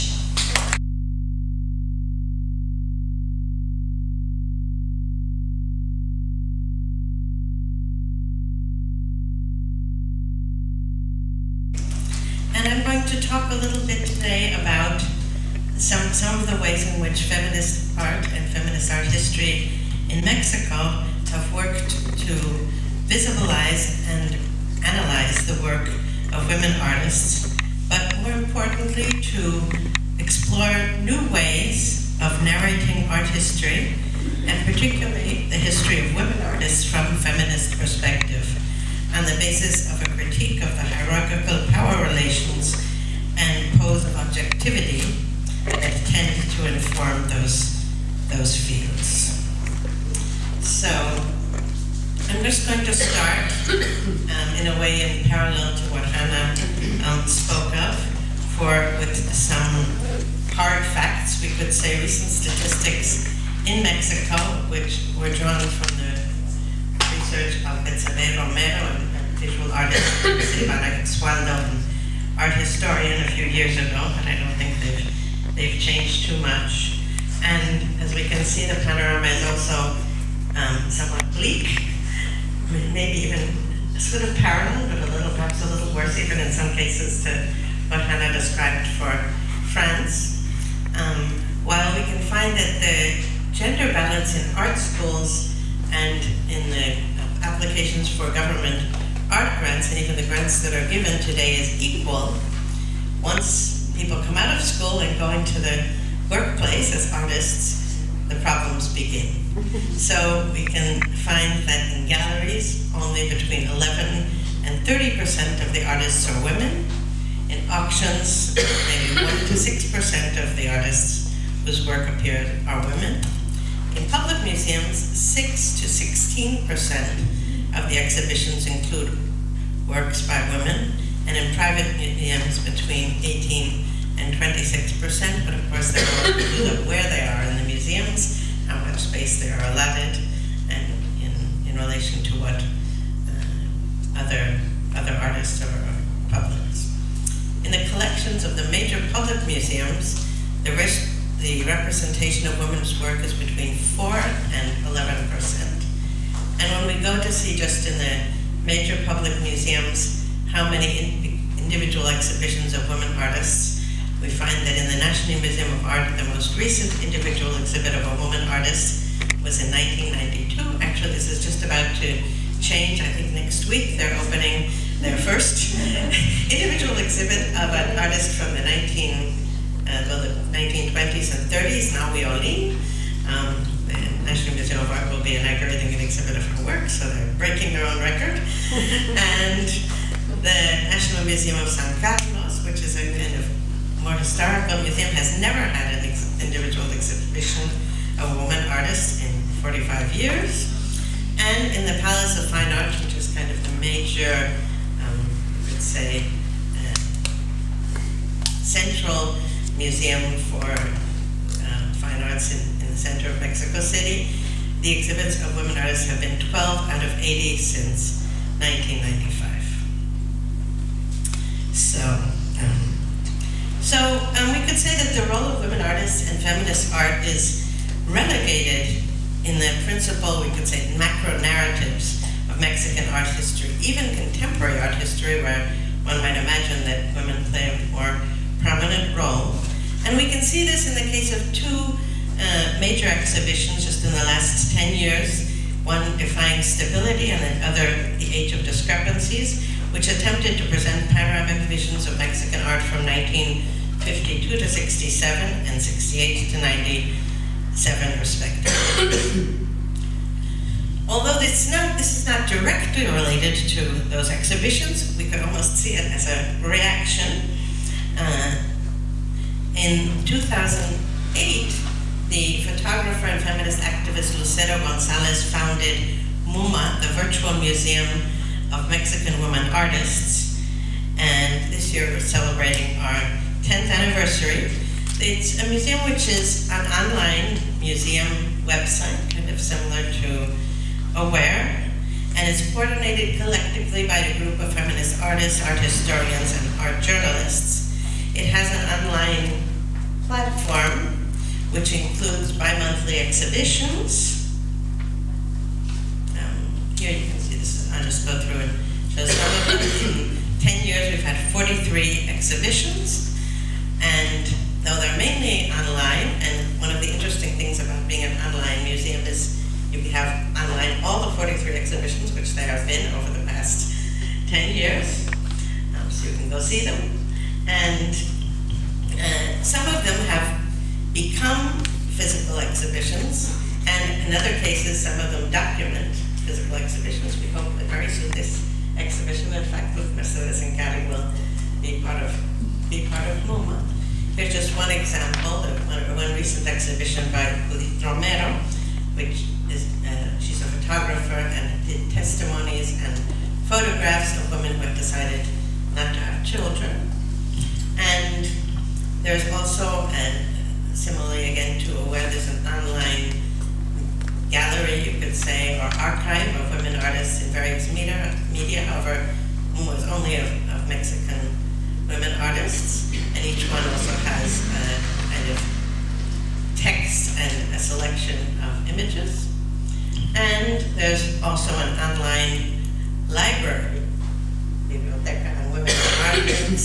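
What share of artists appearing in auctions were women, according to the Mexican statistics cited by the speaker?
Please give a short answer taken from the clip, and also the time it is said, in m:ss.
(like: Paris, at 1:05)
1 to 6%, at 1:59.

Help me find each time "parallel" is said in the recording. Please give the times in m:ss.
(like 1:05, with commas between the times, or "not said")
0:55, 1:24.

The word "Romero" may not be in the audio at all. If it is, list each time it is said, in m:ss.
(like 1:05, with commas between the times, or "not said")
1:08, 5:48.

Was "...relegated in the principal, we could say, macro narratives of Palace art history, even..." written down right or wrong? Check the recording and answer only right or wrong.
wrong.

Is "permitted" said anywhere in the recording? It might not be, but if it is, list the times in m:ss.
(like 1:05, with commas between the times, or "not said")
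not said.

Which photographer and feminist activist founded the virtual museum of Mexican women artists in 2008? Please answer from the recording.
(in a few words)
Lucero Gonzalez.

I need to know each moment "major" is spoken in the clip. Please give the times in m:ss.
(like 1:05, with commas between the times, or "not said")
2:28, 2:38, 3:23, 4:02.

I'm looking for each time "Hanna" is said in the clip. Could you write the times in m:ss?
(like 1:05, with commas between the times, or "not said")
0:56, 1:28.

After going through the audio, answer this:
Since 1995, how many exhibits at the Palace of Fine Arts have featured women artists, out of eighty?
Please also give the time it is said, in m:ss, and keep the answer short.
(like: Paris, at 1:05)
12, at 3:36.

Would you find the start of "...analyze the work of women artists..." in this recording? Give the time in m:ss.
0:24.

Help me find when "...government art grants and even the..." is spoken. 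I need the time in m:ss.
1:38.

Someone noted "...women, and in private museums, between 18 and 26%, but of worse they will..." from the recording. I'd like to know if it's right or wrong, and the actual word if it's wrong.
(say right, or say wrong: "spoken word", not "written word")
wrong: "course", not "worse".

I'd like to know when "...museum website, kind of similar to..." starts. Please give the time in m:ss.
4:47.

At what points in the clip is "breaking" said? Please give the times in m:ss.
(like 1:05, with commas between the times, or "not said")
3:07.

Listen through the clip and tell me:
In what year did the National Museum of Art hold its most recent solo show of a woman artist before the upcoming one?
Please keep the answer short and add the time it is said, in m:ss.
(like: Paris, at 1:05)
1992, at 2:49.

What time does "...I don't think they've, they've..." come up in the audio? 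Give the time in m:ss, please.
1:14.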